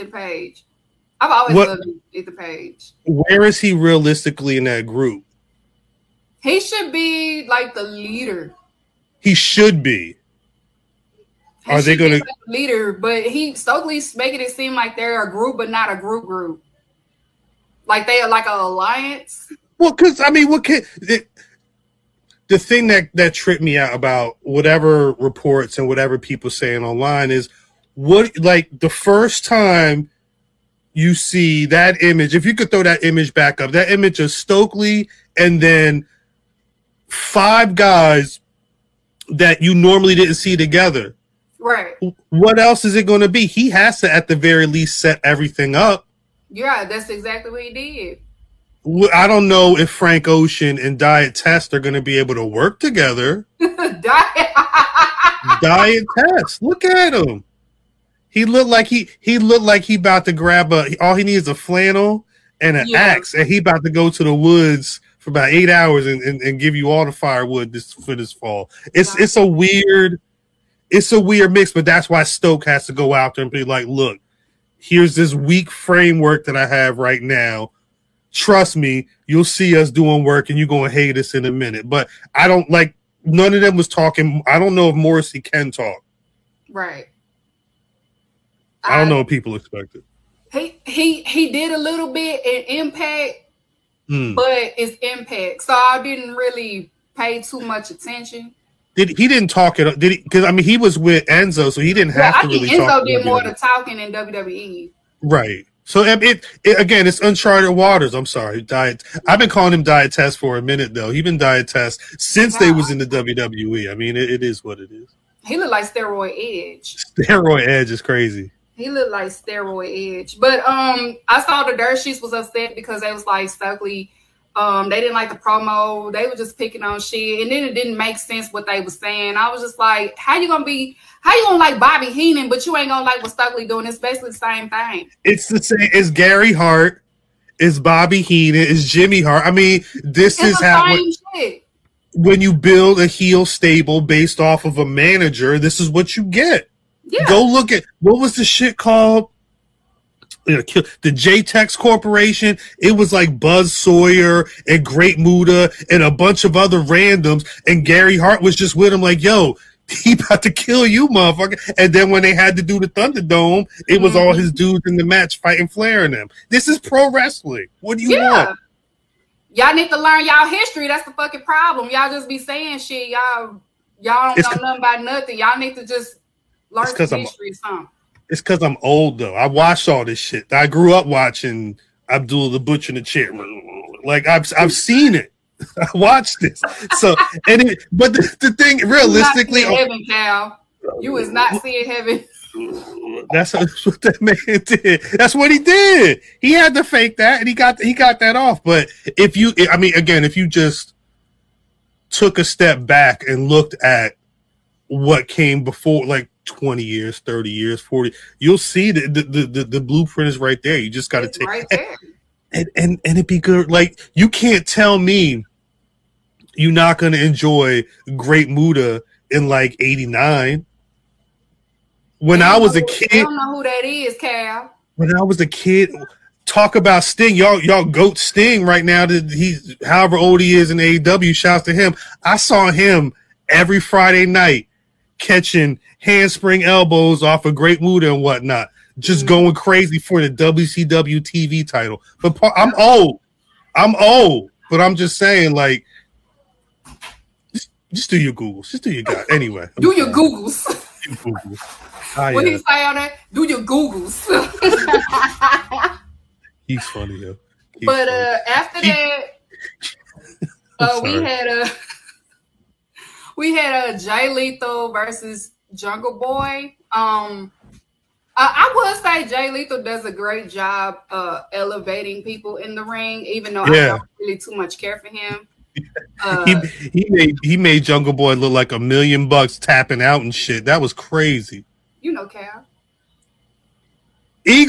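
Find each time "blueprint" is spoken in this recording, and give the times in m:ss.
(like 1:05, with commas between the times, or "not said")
3:29.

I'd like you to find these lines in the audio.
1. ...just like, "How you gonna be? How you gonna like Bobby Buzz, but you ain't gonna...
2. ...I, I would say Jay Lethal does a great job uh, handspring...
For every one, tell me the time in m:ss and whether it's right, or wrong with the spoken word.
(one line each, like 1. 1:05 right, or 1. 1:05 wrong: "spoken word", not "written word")
1. 2:09 wrong: "Heenan", not "Buzz"
2. 4:28 wrong: "elevating", not "handspring".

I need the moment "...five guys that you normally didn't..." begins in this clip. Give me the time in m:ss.
0:37.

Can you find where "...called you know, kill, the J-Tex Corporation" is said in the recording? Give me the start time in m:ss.
2:28.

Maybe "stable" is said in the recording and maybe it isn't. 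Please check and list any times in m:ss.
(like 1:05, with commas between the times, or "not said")
2:23.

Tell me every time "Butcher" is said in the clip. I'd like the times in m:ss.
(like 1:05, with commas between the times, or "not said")
3:02.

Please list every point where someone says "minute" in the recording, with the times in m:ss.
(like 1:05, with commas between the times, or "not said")
1:21, 1:50.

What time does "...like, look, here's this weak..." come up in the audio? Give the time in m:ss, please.
1:13.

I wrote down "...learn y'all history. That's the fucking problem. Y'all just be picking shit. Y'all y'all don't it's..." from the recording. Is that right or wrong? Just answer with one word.
wrong.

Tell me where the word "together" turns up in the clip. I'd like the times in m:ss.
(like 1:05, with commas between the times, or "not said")
0:40, 0:52.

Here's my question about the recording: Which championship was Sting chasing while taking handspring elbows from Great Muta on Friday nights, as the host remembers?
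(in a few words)
WCW TV title.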